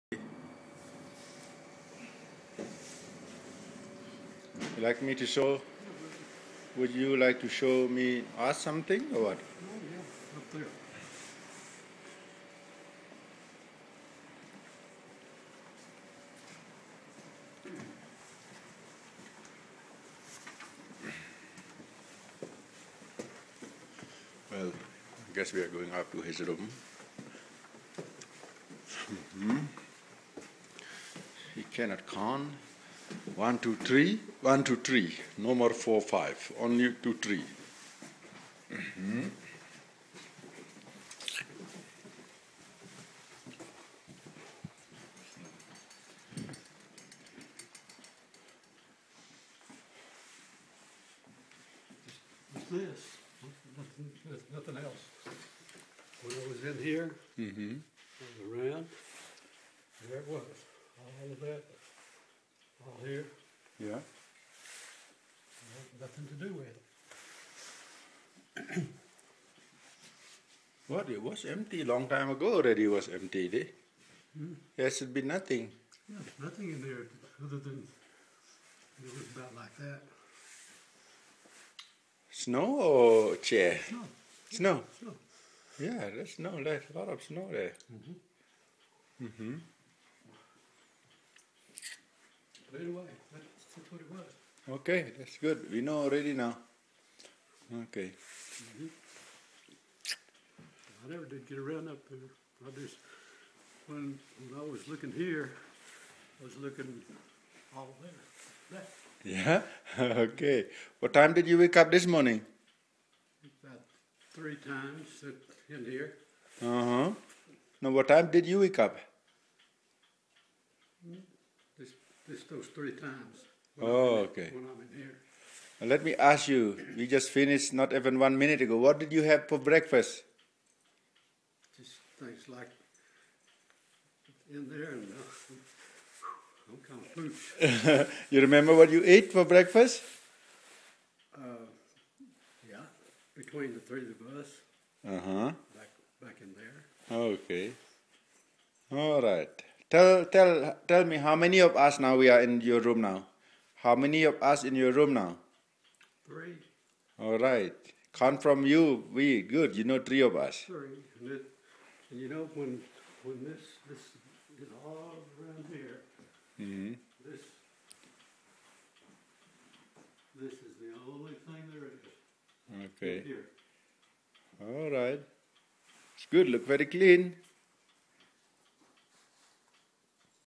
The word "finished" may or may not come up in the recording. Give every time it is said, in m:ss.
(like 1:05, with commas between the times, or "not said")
2:07.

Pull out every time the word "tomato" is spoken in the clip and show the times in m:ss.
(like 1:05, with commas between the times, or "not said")
not said.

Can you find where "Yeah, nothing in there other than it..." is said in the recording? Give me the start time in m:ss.
1:16.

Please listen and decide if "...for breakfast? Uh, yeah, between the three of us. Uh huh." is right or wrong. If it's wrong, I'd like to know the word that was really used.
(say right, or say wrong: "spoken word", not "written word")
right.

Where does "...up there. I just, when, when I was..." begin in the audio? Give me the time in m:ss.
1:41.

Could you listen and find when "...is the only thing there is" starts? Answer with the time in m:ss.
2:50.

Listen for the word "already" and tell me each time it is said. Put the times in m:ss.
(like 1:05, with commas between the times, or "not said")
1:12, 1:36.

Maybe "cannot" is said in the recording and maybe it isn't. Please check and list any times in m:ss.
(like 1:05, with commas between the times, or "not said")
0:31.